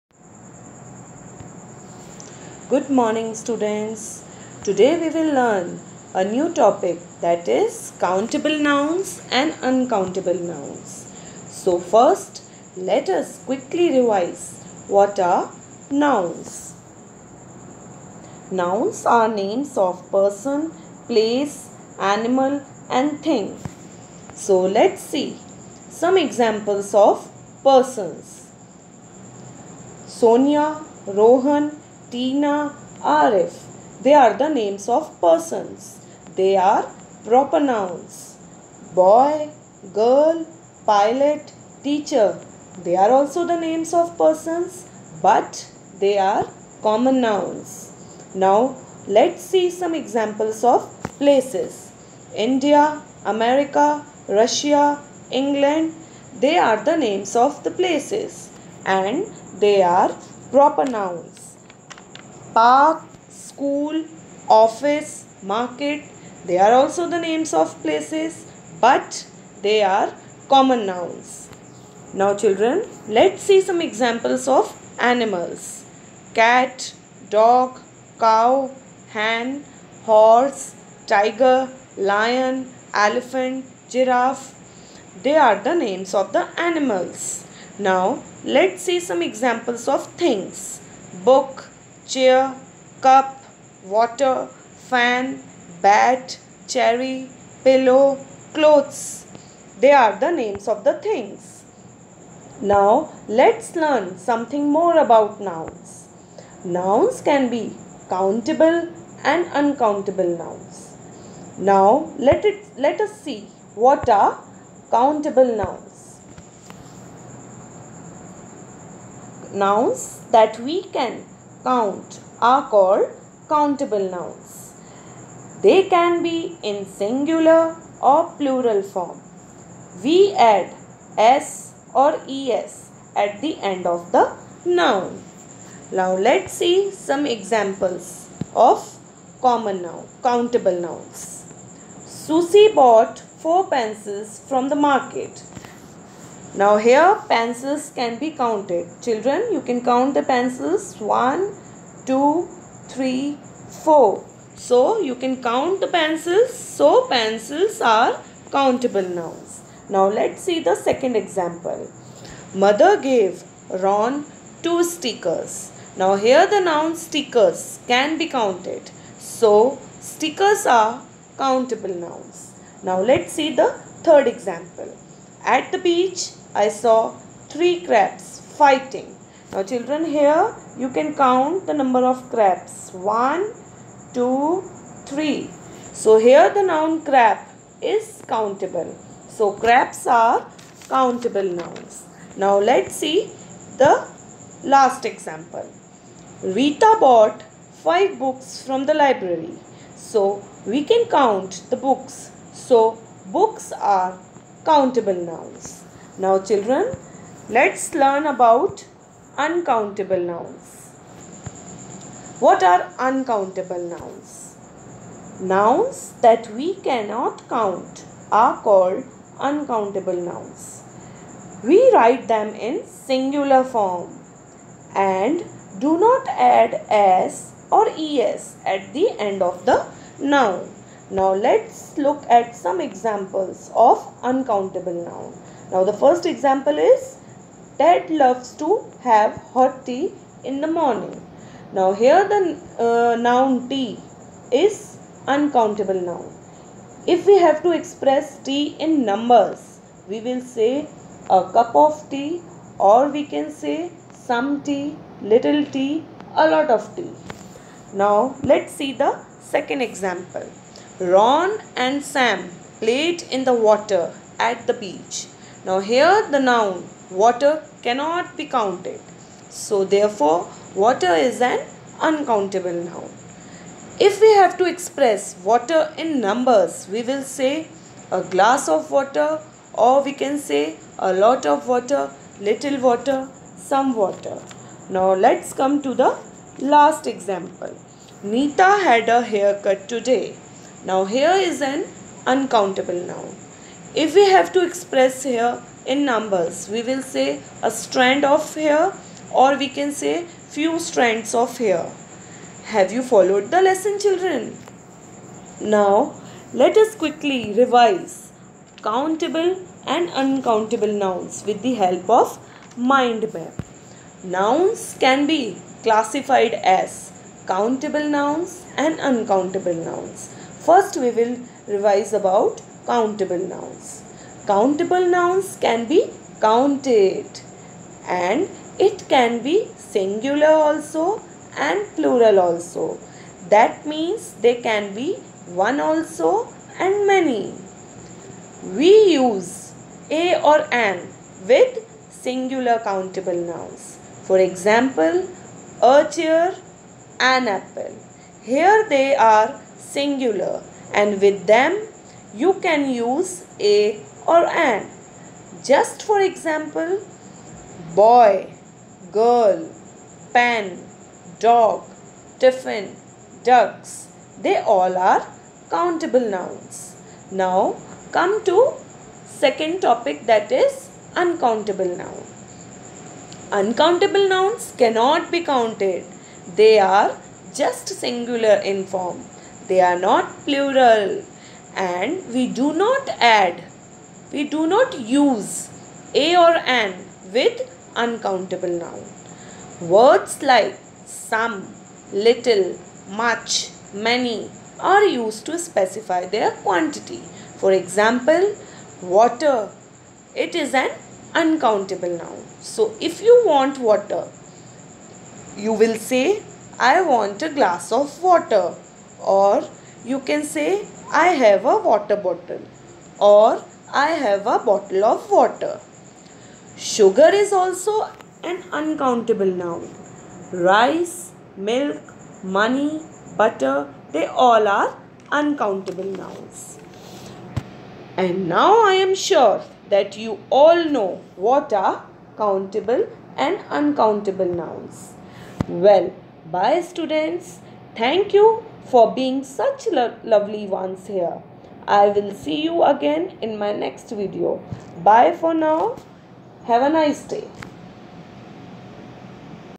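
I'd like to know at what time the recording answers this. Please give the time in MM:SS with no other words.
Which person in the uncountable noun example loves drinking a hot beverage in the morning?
03:57.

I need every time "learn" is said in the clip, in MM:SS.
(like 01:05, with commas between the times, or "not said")
00:05, 01:43, 03:27.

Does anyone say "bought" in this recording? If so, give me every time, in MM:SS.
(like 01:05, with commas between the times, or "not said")
02:22, 03:16.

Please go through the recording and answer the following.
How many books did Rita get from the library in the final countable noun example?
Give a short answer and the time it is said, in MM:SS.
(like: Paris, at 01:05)
5, at 03:17.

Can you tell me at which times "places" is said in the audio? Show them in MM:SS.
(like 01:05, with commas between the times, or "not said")
00:21, 00:51, 00:57, 01:07.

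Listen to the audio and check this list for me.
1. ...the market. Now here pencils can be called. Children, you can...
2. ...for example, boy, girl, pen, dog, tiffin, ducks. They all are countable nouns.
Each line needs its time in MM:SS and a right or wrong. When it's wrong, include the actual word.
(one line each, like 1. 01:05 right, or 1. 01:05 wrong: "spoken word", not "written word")
1. 02:24 wrong: "counted", not "called"
2. 05:56 right.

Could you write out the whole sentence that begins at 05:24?
Countable nouns can be counted and it can be singular also and plural also.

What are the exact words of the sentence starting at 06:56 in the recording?
Sugar is also an uncountable noun.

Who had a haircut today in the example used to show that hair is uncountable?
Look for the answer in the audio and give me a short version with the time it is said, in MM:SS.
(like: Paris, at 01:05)
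Nita, at 04:48.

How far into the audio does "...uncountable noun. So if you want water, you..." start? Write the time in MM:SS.
06:41.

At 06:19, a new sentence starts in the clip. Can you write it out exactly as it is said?
They are not plural and we do not add, we do not use a or an with uncountable noun.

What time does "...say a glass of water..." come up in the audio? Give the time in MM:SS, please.
04:37.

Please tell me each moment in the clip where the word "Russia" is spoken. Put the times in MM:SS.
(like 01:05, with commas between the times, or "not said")
00:54.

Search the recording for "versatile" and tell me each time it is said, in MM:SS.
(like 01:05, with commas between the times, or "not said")
not said.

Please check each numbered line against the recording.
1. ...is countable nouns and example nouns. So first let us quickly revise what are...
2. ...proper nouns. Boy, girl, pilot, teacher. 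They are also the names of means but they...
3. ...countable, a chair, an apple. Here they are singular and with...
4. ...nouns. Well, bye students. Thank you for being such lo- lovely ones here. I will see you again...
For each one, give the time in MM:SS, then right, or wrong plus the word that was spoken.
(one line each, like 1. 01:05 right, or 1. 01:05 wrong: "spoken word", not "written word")
1. 00:07 wrong: "uncountable", not "example"
2. 00:37 wrong: "persons", not "means"
3. 05:44 wrong: "example", not "countable"
4. 07:14 right.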